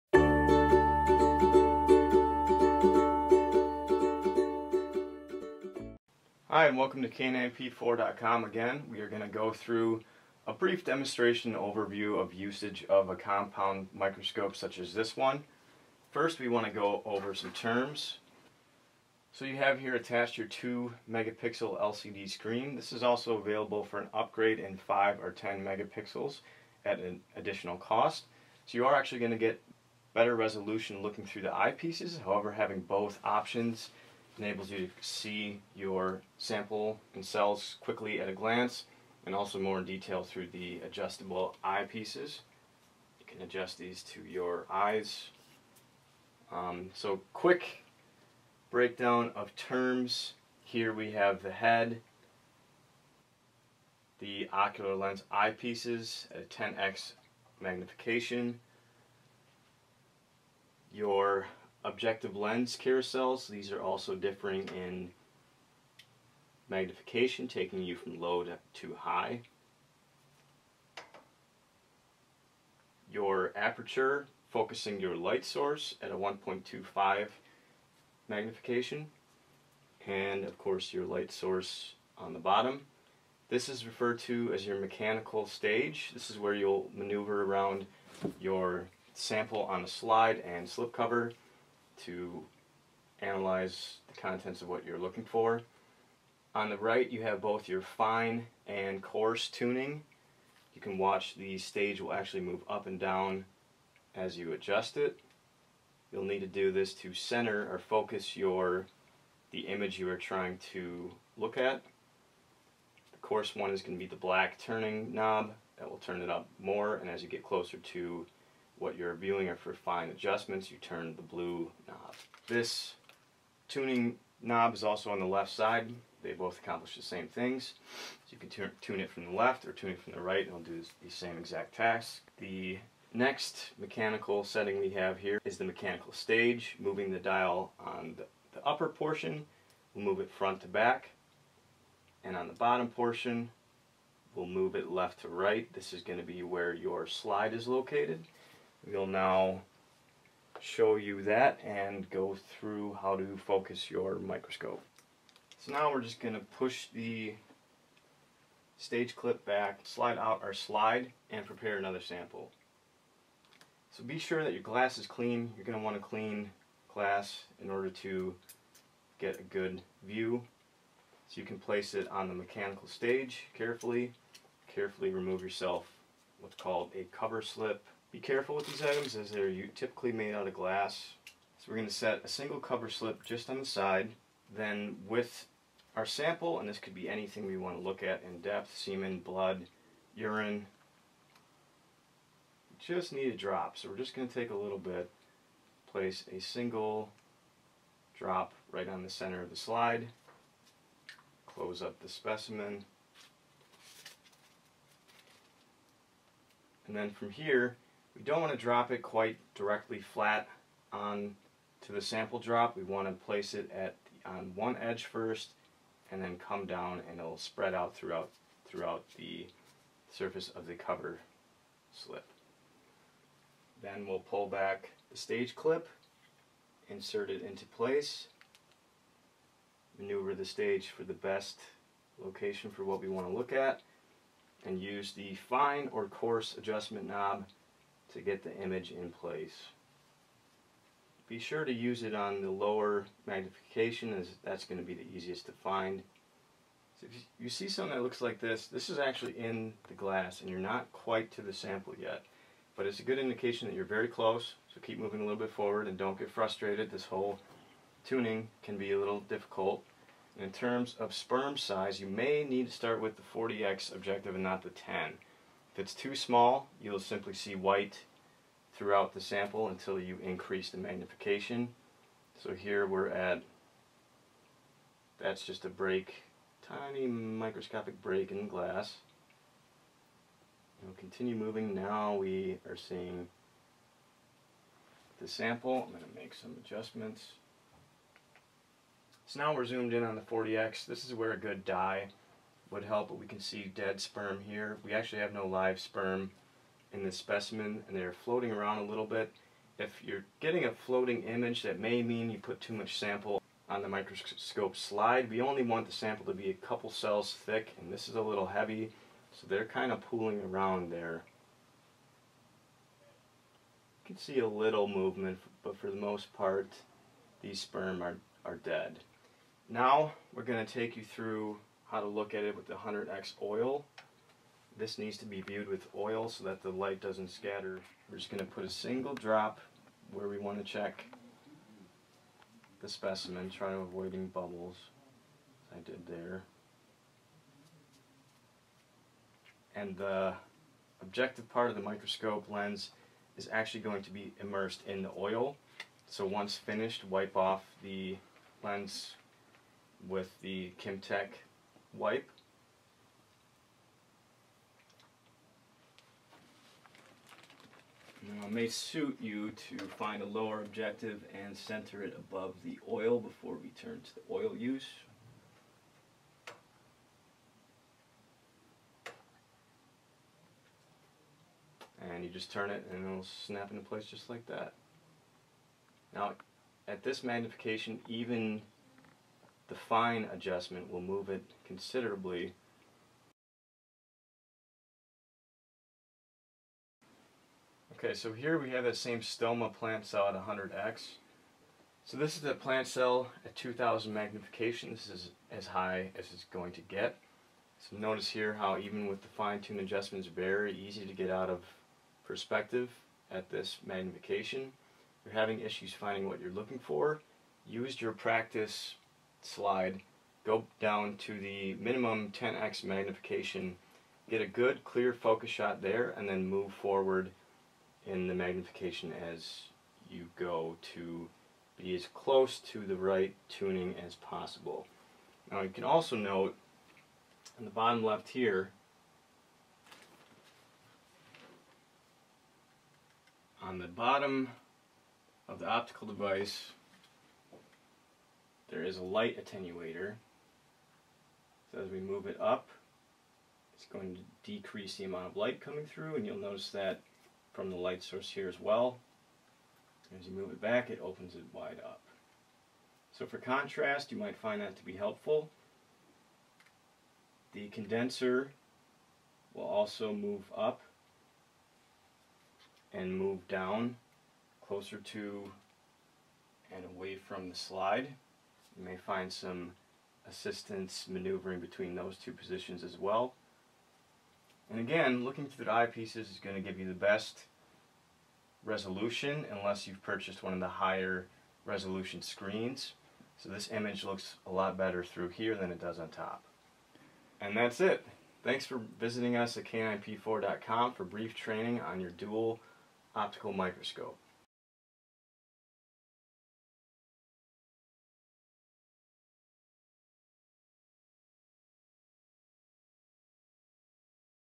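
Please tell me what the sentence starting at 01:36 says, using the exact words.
On the right you have both your fine and coarse tuning.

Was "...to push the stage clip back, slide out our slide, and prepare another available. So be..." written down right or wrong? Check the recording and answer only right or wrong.
wrong.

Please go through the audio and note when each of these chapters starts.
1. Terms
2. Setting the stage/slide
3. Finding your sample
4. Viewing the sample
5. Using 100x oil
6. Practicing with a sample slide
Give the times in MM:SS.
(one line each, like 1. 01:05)
1. 00:20
2. 02:35
3. 04:00
4. 04:50
5. 05:20
6. 06:24.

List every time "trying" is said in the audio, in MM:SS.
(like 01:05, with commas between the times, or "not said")
01:50, 05:33.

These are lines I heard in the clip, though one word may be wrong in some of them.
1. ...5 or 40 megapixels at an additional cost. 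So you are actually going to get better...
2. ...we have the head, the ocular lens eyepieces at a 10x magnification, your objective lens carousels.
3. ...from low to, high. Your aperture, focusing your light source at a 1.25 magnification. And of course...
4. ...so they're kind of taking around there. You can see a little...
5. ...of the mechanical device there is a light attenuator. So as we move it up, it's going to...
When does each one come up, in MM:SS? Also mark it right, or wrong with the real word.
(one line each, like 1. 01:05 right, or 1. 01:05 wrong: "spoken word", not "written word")
1. 00:24 wrong: "10", not "40"
2. 00:50 right
3. 01:07 right
4. 05:09 wrong: "pooling", not "taking"
5. 07:15 wrong: "optical", not "mechanical".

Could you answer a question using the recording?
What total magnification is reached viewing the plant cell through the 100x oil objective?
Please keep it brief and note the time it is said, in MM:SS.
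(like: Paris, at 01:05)
2000, at 06:33.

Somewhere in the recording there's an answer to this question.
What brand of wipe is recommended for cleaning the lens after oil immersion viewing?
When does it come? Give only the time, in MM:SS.
05:50.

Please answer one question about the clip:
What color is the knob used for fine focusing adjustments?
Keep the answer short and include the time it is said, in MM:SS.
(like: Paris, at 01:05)
Blue, at 02:01.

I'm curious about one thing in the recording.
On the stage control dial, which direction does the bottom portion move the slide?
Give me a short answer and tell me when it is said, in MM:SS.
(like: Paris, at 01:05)
Left to right, at 02:24.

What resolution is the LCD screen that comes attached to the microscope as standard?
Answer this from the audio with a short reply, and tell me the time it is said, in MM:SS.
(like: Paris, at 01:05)
2 megapixel, at 00:20.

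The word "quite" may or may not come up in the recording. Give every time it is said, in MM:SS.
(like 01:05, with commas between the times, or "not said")
03:29, 04:10.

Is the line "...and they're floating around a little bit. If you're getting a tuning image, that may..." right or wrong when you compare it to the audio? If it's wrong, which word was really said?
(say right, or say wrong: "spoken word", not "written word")
wrong: "floating", not "tuning".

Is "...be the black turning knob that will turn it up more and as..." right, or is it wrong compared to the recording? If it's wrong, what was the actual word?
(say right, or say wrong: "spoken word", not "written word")
right.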